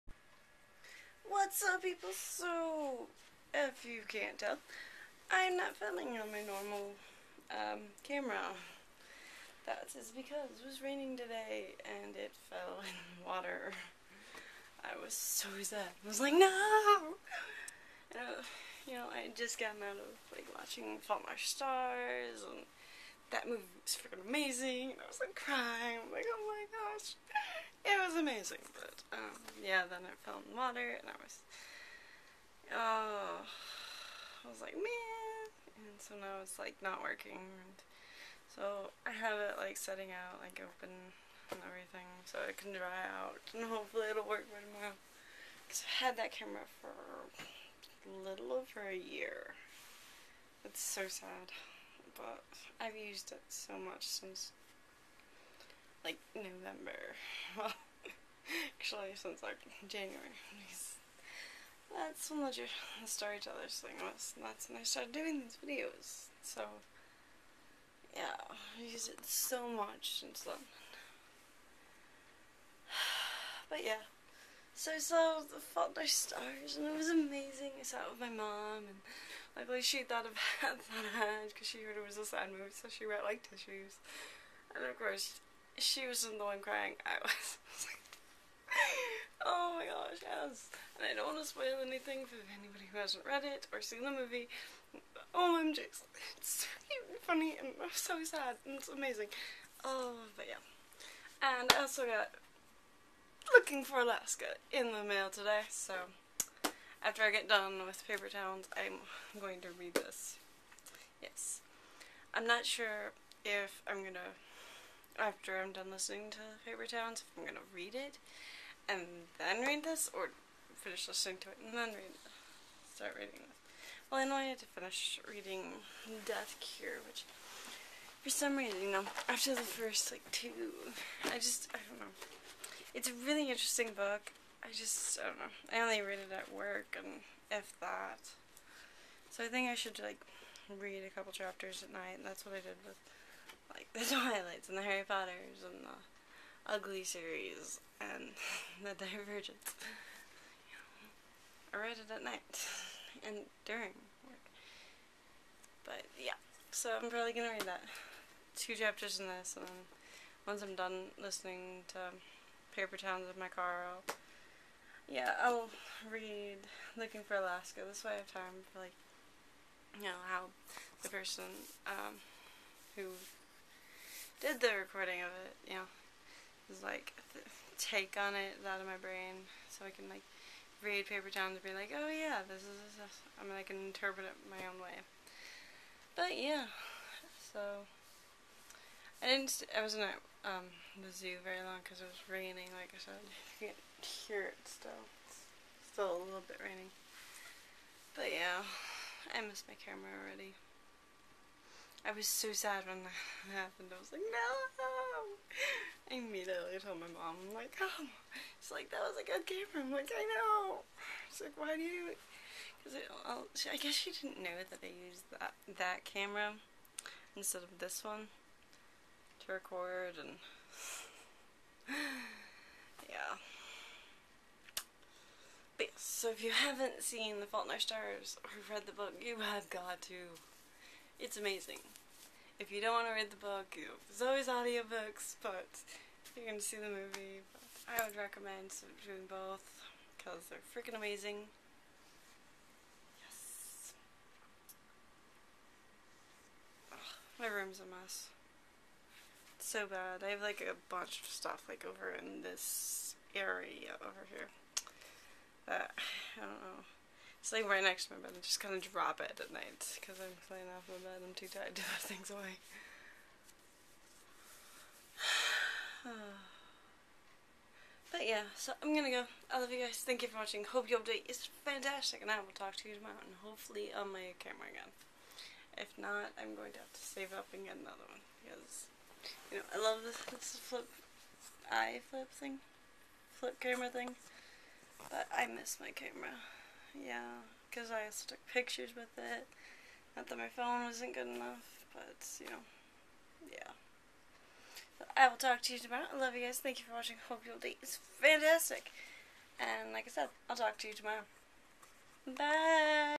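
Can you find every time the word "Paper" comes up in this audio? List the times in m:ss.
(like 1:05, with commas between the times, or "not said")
1:48, 1:56, 2:42, 3:01.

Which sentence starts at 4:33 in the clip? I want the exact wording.
And hopefully, on my camera again.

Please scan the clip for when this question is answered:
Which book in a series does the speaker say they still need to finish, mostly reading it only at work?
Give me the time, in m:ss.
2:06.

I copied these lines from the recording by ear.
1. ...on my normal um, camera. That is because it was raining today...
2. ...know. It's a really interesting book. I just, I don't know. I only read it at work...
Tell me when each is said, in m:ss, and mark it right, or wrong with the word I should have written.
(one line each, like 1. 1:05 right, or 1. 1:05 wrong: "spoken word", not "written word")
1. 0:06 right
2. 2:11 right.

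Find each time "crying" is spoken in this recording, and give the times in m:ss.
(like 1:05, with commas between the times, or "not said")
0:25, 1:26.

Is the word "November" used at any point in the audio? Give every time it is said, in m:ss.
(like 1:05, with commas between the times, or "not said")
0:56.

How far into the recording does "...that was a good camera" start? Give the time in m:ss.
3:28.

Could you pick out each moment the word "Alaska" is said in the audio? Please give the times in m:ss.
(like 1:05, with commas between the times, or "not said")
1:44, 2:47.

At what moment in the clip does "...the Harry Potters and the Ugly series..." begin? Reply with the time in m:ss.
2:24.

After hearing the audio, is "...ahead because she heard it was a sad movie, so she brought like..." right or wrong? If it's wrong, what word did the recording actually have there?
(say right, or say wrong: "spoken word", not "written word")
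right.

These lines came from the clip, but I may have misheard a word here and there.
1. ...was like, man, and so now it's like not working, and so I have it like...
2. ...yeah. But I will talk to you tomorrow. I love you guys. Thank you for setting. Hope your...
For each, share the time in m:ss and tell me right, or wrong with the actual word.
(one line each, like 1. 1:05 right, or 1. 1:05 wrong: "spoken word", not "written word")
1. 0:34 right
2. 4:53 wrong: "watching", not "setting".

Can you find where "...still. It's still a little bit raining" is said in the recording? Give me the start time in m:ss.
3:14.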